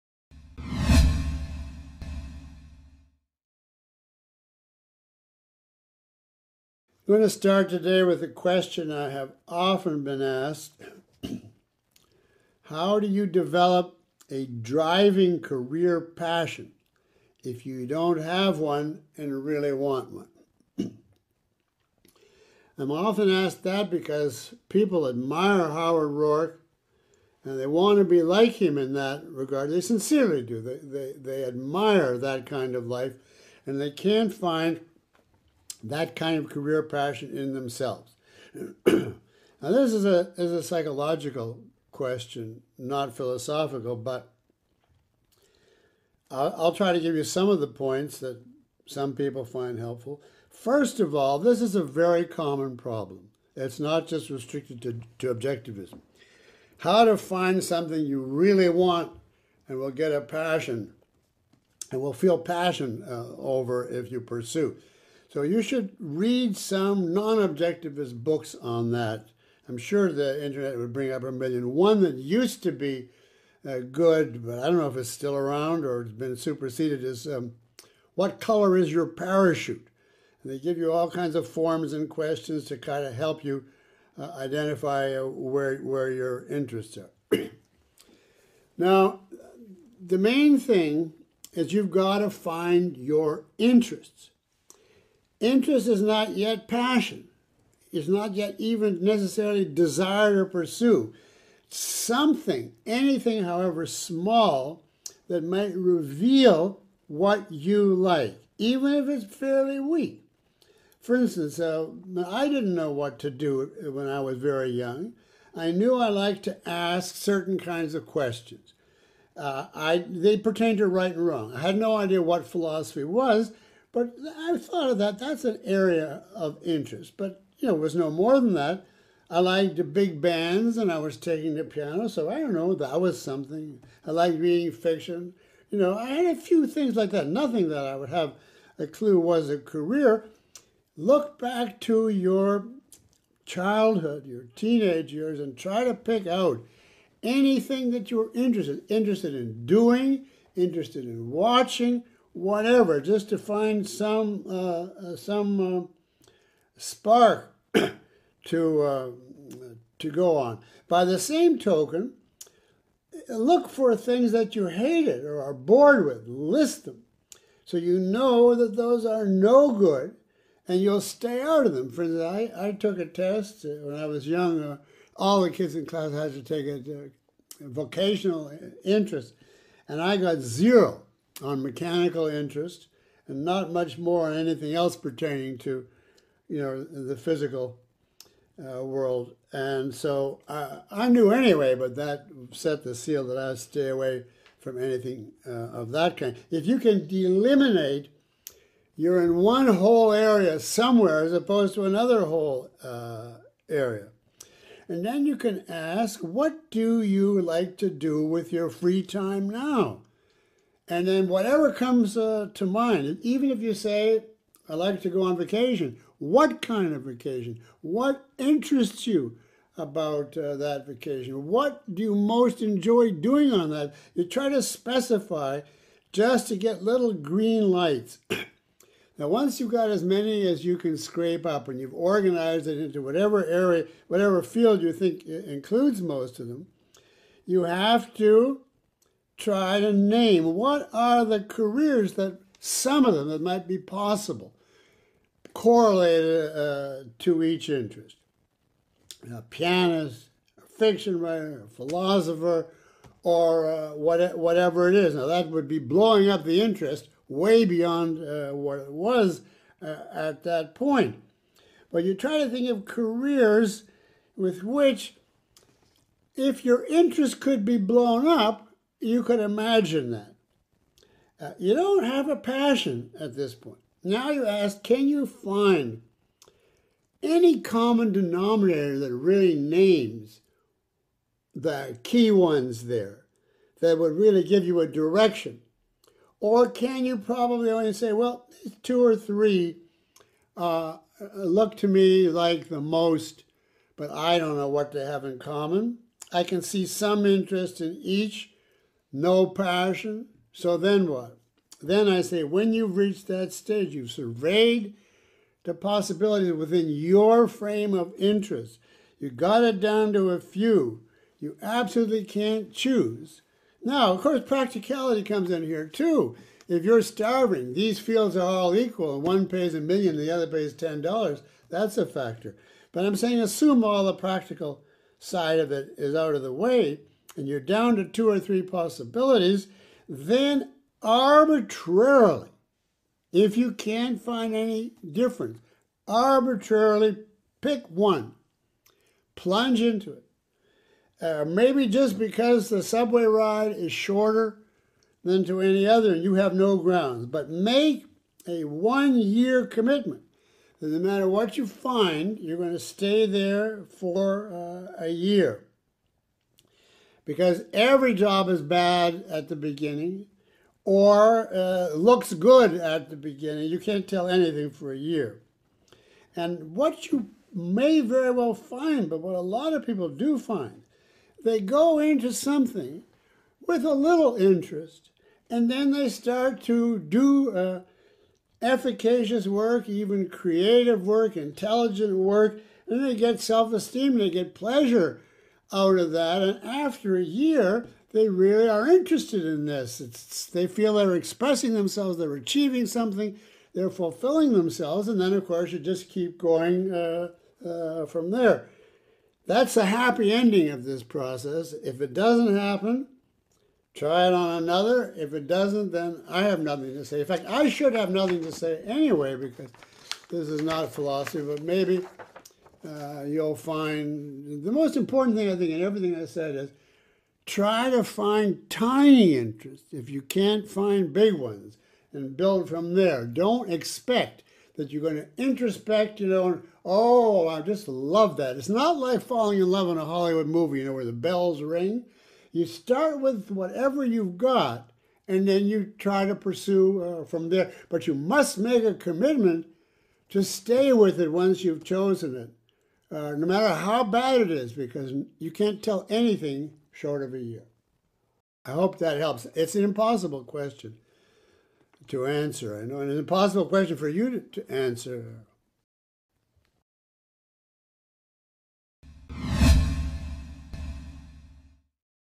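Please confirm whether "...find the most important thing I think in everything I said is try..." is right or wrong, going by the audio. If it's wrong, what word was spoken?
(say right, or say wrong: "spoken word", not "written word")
right.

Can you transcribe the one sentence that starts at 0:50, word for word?
First of all, this is a very common problem.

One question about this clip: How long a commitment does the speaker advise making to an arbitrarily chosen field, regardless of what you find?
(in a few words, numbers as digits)
1 year.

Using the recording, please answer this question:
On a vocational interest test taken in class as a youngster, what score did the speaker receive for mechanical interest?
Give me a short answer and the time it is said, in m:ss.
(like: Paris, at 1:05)
0, at 3:00.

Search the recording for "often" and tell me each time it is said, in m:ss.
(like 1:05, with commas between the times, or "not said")
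0:09, 0:22.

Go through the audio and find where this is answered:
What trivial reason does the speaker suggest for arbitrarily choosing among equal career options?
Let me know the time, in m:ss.
5:42.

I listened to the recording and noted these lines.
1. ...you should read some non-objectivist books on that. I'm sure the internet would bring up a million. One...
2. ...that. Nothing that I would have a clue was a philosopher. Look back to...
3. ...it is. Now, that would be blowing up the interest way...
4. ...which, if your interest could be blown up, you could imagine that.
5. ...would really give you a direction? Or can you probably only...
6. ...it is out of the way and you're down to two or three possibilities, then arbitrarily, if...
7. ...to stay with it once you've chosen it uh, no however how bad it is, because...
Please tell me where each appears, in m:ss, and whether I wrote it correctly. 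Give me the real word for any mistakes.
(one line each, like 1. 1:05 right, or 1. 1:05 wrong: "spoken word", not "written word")
1. 1:05 right
2. 2:17 wrong: "career", not "philosopher"
3. 4:14 right
4. 4:24 right
5. 4:43 right
6. 5:25 right
7. 7:20 wrong: "matter", not "however".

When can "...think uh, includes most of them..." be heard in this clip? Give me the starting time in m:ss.
3:54.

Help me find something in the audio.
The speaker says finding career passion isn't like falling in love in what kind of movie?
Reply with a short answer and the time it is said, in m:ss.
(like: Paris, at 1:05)
Hollywood movie, at 7:10.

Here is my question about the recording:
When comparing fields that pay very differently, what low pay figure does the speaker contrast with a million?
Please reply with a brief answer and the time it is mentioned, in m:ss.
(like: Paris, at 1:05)
$10, at 5:20.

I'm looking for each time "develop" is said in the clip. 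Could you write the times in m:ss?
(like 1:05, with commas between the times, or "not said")
0:13.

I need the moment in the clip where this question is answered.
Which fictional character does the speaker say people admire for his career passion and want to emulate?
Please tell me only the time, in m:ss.
0:25.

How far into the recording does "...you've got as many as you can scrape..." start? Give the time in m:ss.
3:49.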